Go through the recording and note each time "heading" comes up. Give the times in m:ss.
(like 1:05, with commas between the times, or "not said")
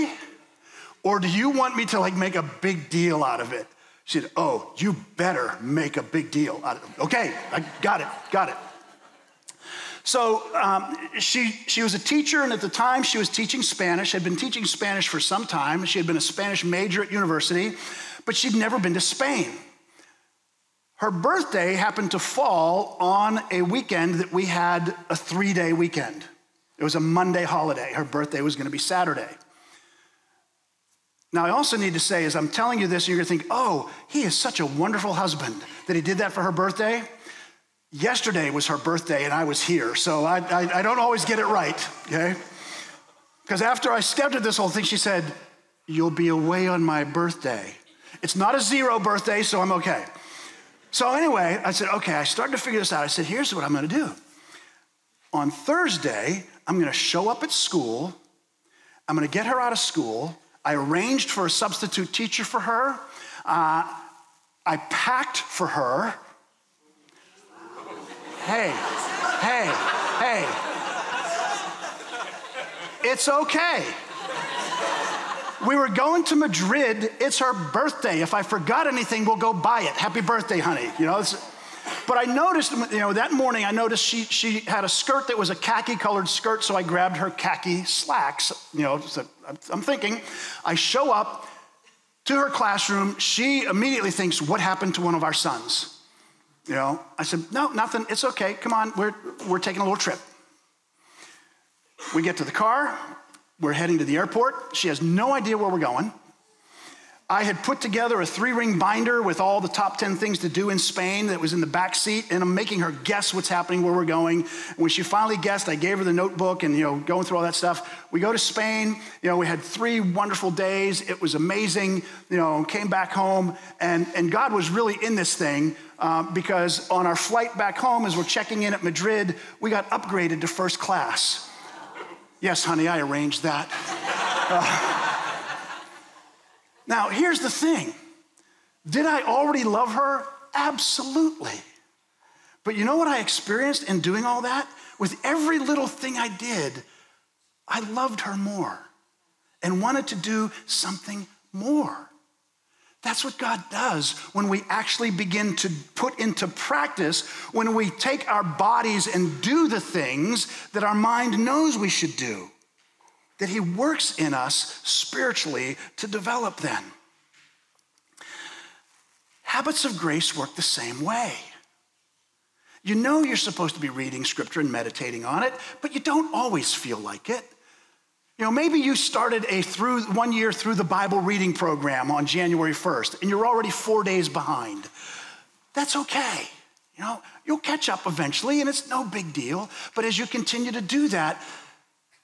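1:43.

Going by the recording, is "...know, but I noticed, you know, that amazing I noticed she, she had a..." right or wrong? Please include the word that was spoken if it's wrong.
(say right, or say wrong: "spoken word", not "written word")
wrong: "morning", not "amazing".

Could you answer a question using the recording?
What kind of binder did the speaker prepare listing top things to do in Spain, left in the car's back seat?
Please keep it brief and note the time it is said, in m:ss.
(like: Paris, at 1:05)
three ring binder, at 1:48.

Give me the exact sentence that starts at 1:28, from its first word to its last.
You know, so I'm thinking, I show up to her classroom.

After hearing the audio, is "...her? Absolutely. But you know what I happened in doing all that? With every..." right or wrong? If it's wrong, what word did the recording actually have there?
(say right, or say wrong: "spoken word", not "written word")
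wrong: "experienced", not "happened".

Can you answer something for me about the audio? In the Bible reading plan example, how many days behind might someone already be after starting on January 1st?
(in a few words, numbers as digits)
4 days.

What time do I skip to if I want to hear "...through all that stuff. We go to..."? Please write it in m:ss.
1:57.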